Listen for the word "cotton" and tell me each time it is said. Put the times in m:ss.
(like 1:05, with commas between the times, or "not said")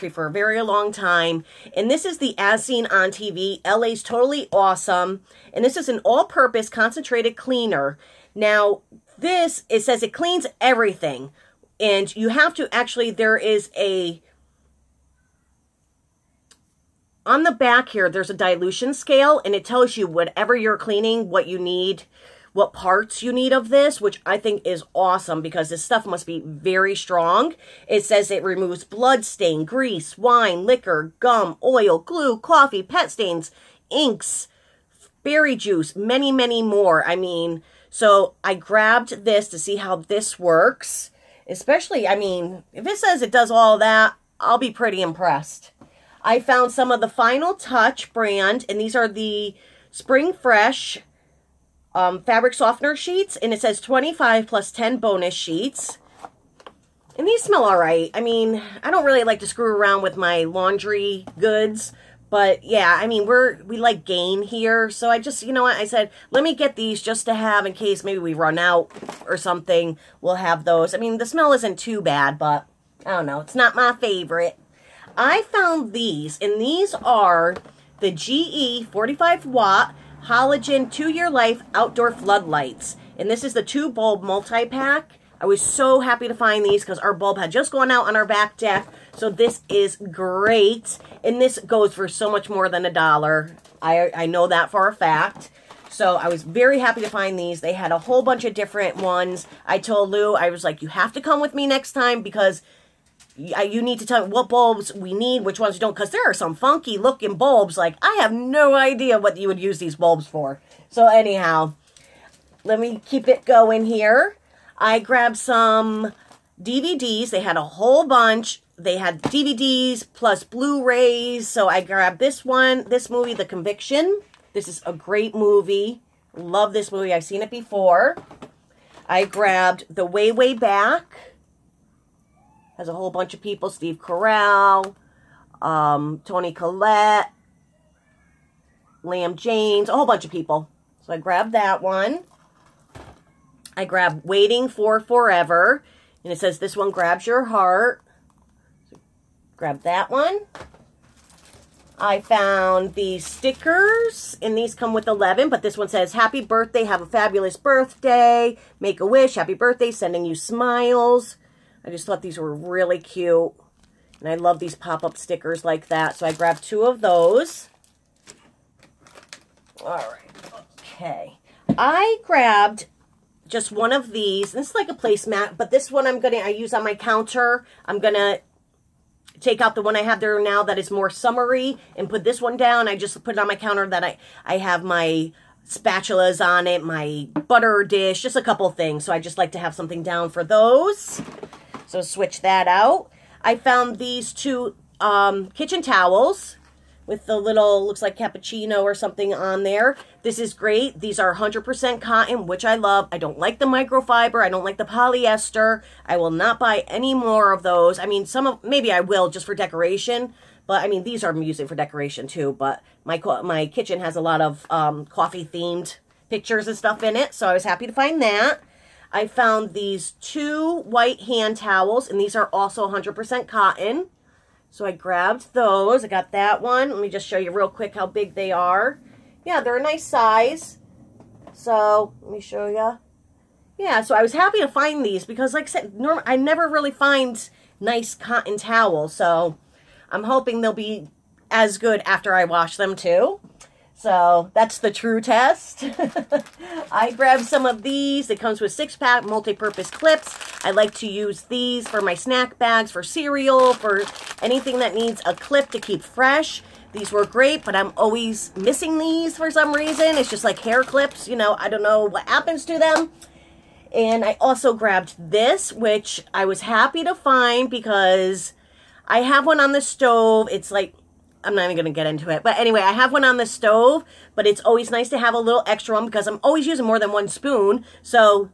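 3:22, 3:43, 3:58.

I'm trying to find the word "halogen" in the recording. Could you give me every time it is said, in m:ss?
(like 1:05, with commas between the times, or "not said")
1:20.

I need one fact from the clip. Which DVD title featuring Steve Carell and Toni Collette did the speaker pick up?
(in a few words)
The Way, Way Back.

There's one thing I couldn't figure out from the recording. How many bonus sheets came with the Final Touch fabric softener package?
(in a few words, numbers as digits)
10.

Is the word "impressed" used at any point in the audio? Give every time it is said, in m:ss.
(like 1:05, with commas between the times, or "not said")
0:45.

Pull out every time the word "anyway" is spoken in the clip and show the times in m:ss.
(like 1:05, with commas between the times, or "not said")
4:32.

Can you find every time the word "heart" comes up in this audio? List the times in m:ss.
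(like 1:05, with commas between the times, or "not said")
2:27.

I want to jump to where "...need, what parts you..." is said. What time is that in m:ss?
0:21.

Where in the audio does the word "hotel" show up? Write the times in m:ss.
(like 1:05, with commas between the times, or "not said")
not said.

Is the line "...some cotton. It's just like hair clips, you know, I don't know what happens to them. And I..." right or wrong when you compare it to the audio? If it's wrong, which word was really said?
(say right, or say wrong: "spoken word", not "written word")
wrong: "reason", not "cotton".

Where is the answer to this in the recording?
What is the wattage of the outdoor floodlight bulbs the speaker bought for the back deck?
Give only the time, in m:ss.
1:18.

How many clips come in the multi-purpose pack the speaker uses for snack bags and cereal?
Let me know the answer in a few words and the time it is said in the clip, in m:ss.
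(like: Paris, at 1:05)
6, at 4:08.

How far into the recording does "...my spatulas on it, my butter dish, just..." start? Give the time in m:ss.
3:04.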